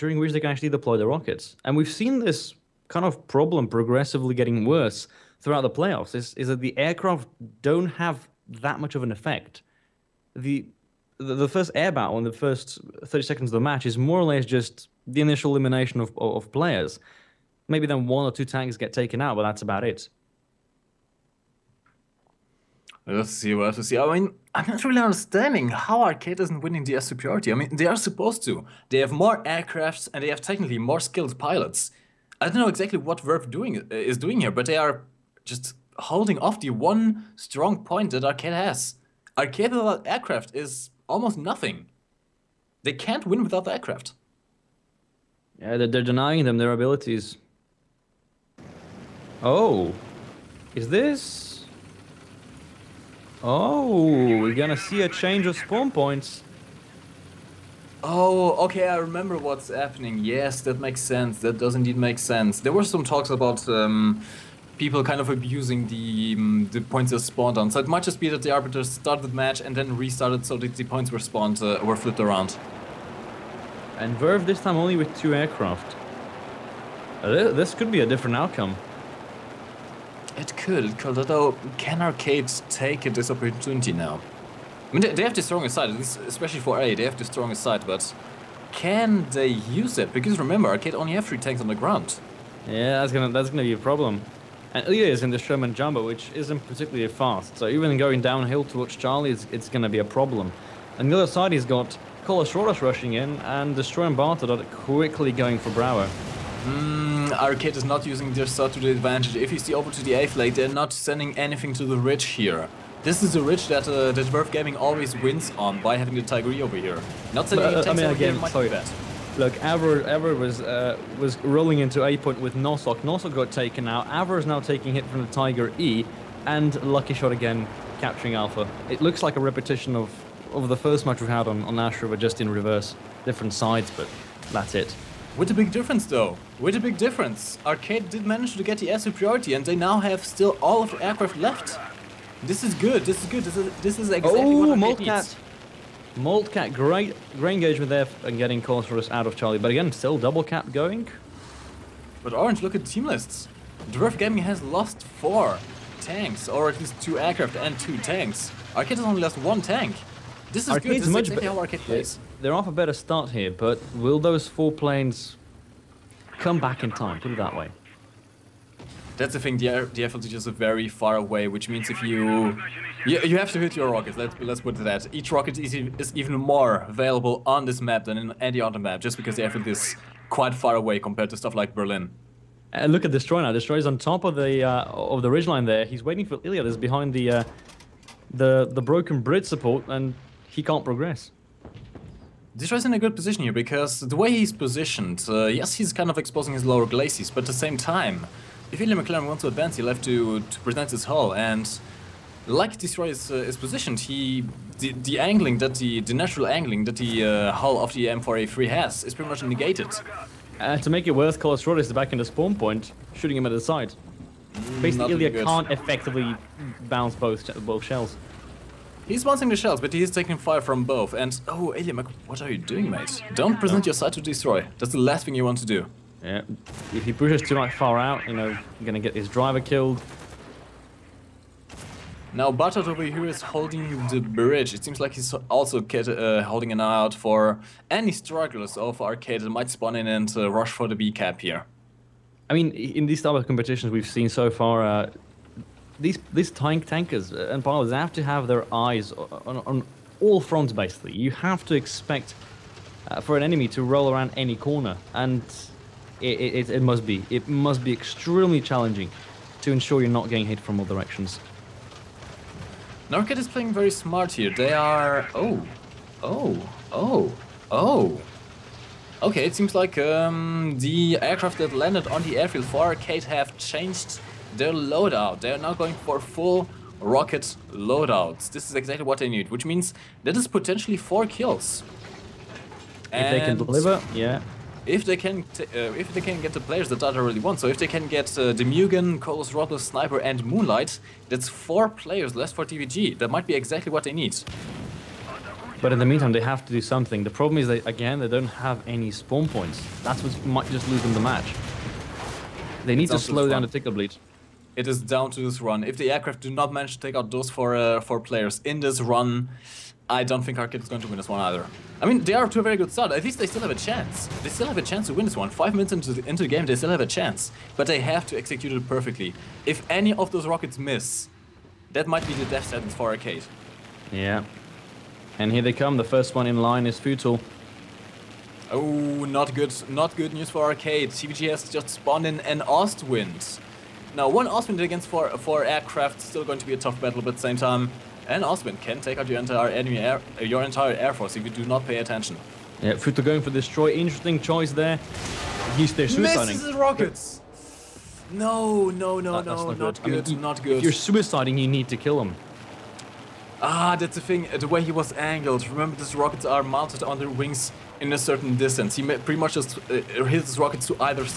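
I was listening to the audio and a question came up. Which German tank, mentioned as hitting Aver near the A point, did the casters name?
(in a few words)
Tiger E.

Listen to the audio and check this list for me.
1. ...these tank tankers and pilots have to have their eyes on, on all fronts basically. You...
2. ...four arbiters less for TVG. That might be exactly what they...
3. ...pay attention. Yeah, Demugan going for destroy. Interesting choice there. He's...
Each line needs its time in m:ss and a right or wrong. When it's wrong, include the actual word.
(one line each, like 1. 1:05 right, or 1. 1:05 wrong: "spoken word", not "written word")
1. 4:06 right
2. 4:51 wrong: "players", not "arbiters"
3. 5:41 wrong: "Futo", not "Demugan".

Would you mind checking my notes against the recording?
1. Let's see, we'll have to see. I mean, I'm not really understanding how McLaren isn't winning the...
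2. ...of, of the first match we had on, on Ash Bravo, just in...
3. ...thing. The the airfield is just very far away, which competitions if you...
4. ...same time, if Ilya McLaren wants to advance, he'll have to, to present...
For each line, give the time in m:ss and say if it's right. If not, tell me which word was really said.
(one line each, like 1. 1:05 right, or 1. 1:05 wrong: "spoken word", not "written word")
1. 0:23 wrong: "Arcade", not "McLaren"
2. 2:09 wrong: "River", not "Bravo"
3. 2:49 wrong: "means", not "competitions"
4. 3:17 right.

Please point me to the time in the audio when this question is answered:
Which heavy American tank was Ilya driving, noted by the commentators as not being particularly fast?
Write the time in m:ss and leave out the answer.
1:35.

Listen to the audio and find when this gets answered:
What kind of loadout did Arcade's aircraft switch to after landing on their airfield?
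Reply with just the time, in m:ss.
4:36.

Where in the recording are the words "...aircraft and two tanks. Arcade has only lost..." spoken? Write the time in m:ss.
2:37.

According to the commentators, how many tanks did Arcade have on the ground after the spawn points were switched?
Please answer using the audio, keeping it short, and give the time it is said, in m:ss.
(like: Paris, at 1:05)
3, at 1:31.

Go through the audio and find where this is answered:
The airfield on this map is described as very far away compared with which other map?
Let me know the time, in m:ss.
3:01.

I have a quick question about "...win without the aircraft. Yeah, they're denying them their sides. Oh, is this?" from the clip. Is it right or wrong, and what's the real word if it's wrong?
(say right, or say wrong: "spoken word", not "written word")
wrong: "abilities", not "sides".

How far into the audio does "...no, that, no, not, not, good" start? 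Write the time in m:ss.
5:49.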